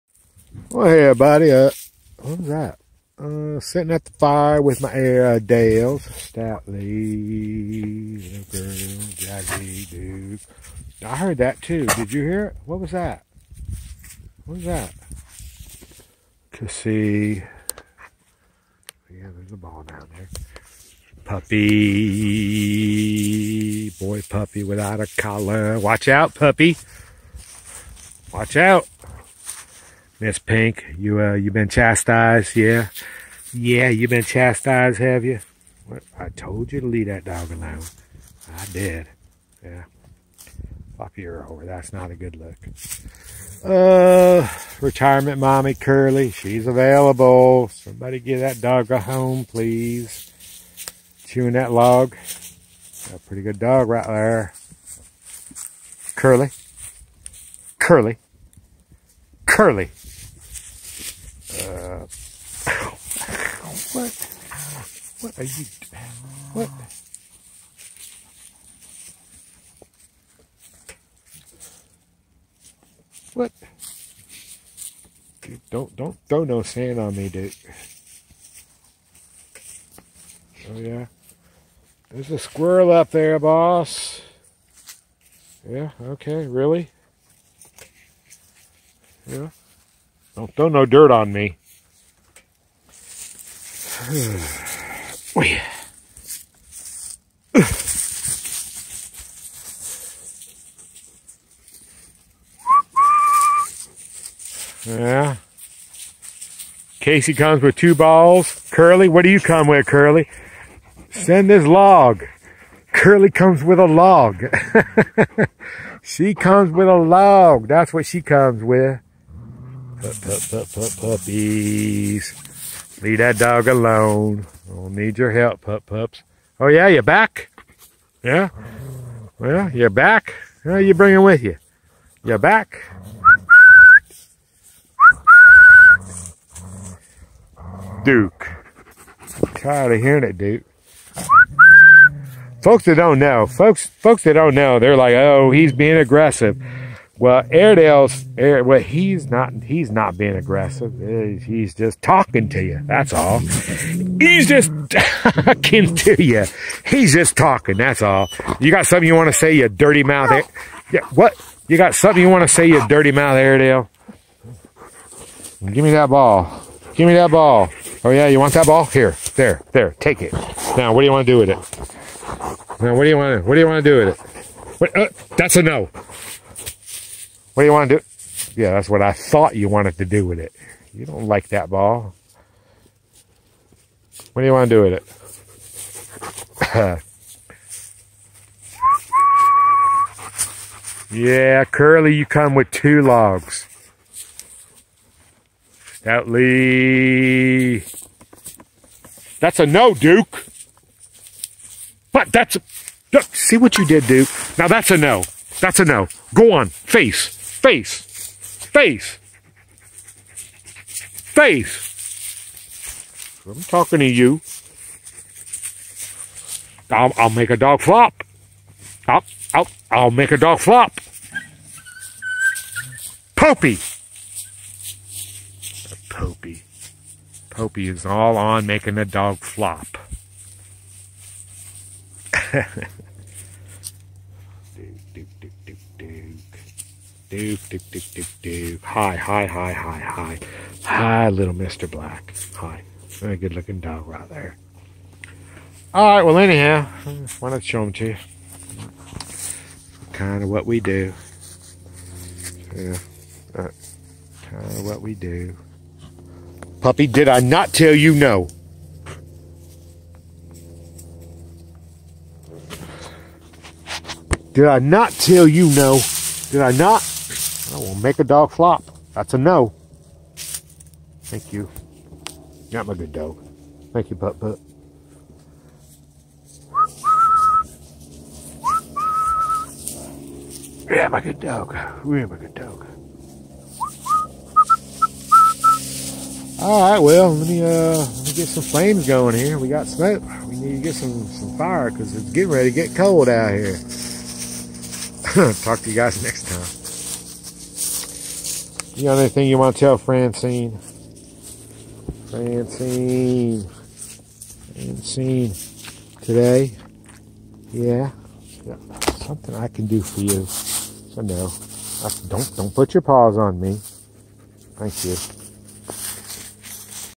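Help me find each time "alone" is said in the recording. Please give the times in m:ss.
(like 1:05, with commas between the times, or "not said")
0:37, 2:03.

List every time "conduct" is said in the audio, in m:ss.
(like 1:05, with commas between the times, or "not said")
not said.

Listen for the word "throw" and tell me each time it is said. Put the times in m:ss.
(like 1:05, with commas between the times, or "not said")
1:16, 1:30.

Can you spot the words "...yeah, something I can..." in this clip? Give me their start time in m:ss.
5:08.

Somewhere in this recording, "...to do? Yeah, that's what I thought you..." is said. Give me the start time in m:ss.
2:57.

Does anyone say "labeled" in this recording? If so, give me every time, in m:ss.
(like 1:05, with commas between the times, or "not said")
not said.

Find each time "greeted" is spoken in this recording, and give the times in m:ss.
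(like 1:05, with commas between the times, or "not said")
not said.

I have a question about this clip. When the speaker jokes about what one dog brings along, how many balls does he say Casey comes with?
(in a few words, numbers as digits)
2.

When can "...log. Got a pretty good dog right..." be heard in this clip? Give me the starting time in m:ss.
0:51.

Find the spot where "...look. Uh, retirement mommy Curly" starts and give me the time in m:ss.
0:42.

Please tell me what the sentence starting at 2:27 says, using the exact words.
Well, Airedale's well, he's not he's not being aggressive.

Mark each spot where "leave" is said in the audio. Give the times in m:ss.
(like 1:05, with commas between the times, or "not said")
0:36, 2:03.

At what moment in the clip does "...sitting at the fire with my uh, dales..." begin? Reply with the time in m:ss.
0:03.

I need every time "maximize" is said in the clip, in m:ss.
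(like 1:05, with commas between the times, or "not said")
not said.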